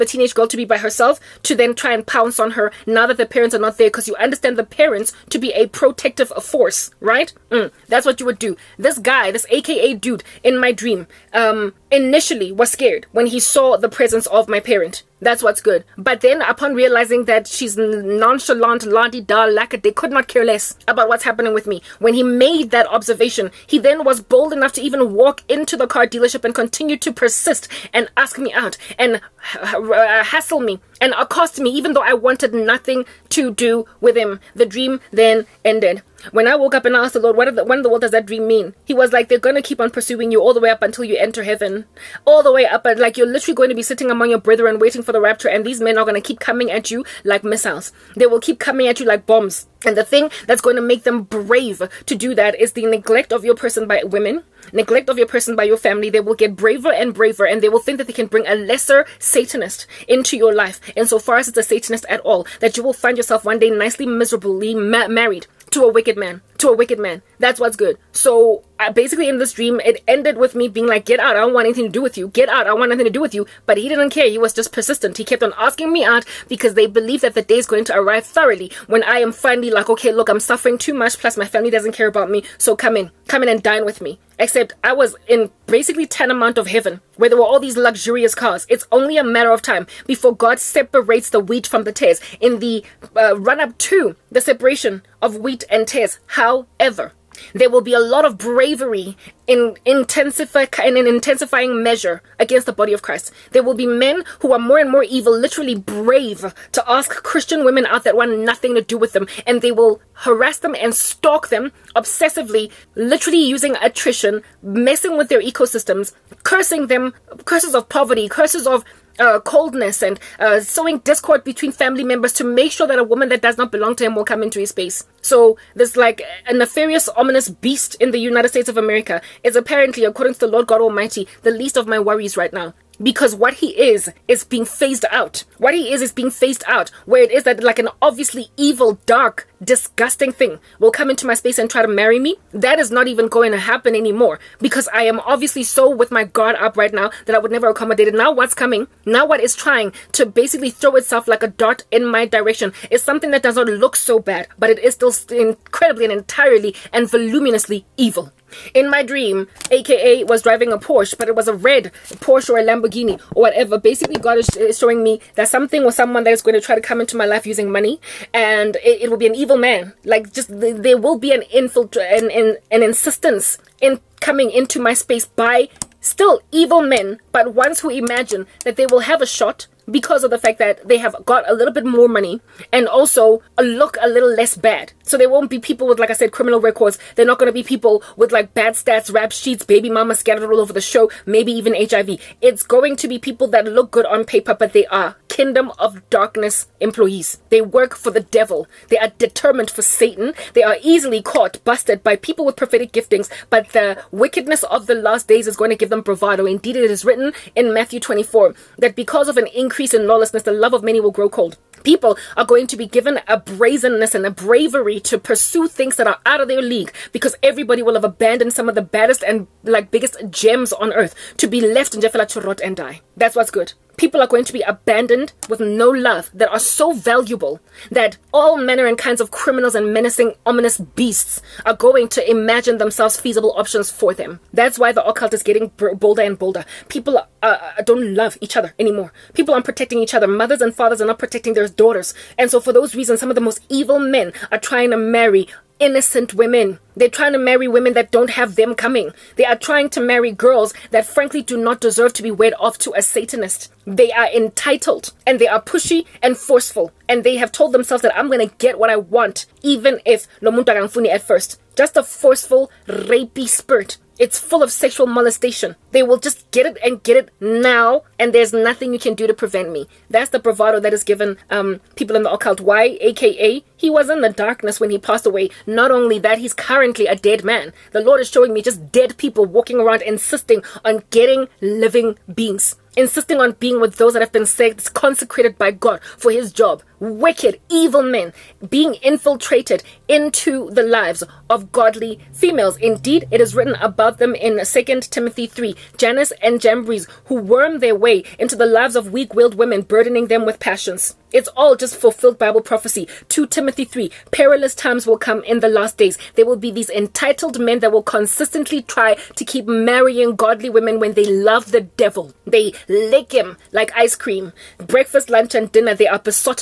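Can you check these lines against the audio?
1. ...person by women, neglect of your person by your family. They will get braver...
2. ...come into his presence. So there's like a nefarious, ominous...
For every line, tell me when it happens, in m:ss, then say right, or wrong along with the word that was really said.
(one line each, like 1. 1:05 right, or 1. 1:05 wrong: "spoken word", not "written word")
1. 0:53 right
2. 2:04 wrong: "space", not "presence".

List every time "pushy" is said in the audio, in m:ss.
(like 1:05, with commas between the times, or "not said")
4:15.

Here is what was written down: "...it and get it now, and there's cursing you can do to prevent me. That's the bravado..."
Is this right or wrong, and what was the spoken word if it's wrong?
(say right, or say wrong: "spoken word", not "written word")
wrong: "nothing", not "cursing".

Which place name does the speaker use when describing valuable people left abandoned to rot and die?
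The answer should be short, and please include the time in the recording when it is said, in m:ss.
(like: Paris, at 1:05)
Jaffa, at 3:42.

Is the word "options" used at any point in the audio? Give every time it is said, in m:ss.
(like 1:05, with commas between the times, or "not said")
3:53.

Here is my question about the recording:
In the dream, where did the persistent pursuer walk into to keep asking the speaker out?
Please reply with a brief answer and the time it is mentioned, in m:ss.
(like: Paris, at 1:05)
car dealership, at 0:25.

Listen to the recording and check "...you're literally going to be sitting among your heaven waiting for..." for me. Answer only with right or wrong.
wrong.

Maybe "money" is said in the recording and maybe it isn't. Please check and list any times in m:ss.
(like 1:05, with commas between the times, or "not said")
2:47, 3:02.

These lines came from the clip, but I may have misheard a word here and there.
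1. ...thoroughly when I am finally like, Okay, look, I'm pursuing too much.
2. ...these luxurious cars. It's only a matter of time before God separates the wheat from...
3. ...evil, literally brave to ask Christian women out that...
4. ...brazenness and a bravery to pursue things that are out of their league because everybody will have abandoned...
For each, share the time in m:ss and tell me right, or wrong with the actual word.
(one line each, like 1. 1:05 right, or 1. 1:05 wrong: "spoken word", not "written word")
1. 1:18 wrong: "suffering", not "pursuing"
2. 1:27 right
3. 1:45 right
4. 3:33 right.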